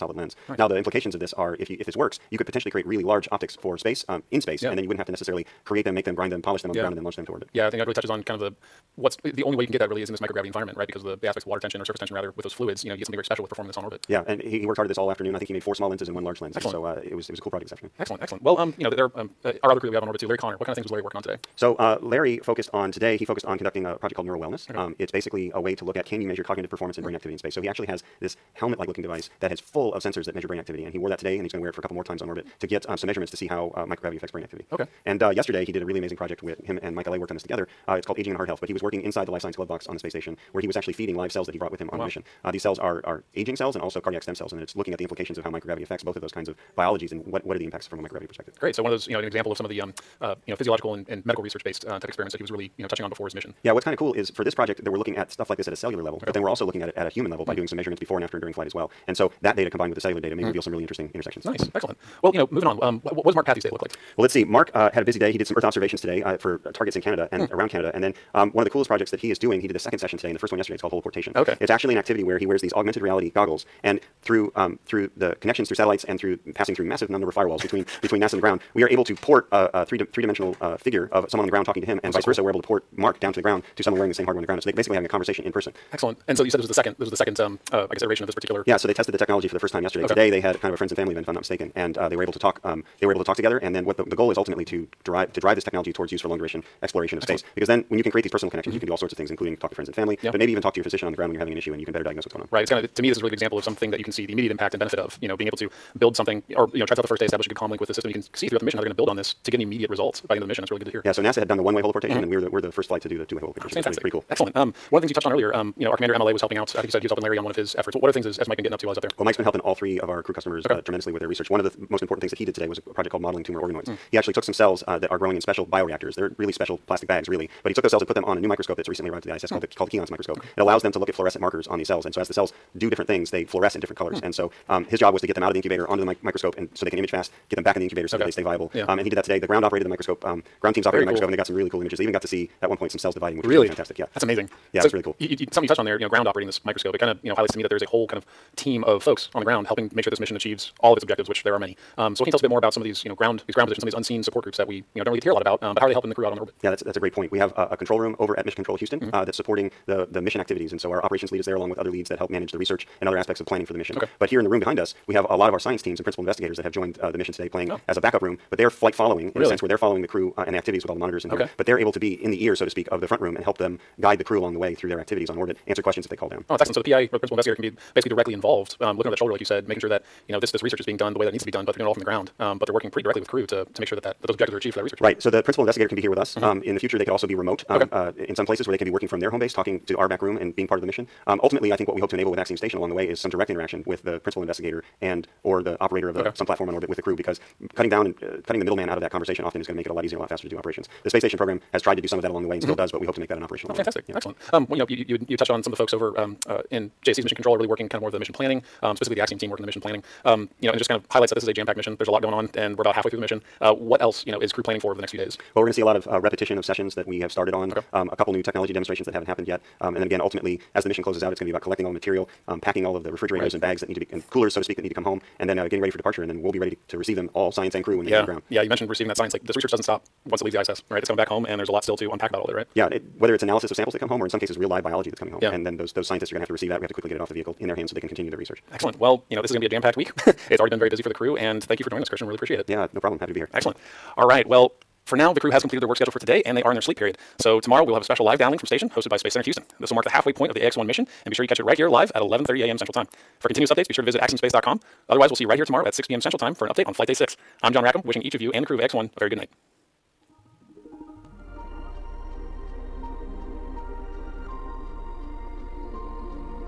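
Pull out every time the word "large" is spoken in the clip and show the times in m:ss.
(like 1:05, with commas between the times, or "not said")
0:03, 0:16.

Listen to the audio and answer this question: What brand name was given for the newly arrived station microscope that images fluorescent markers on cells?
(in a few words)
Keyence.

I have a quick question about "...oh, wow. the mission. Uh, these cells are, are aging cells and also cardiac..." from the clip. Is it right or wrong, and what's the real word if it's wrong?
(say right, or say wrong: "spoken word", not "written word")
right.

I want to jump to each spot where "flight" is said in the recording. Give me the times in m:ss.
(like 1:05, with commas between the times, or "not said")
0:58, 1:52, 2:48, 4:16.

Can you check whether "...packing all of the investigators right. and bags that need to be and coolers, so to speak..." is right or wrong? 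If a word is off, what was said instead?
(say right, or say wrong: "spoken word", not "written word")
wrong: "refrigerators", not "investigators".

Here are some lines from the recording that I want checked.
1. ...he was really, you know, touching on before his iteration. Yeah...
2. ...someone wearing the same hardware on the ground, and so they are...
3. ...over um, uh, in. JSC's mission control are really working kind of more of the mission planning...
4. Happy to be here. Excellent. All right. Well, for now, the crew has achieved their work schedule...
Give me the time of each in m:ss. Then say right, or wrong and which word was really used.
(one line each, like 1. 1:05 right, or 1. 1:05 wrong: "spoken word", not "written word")
1. 0:52 wrong: "mission", not "iteration"
2. 1:23 right
3. 3:25 right
4. 4:03 wrong: "completed", not "achieved".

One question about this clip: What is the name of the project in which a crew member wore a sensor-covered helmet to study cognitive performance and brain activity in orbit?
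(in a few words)
Neuro Wellness.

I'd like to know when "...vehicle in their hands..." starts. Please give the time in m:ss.
3:57.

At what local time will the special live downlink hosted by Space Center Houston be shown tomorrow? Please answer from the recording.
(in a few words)
11:30 a.m. Central Time.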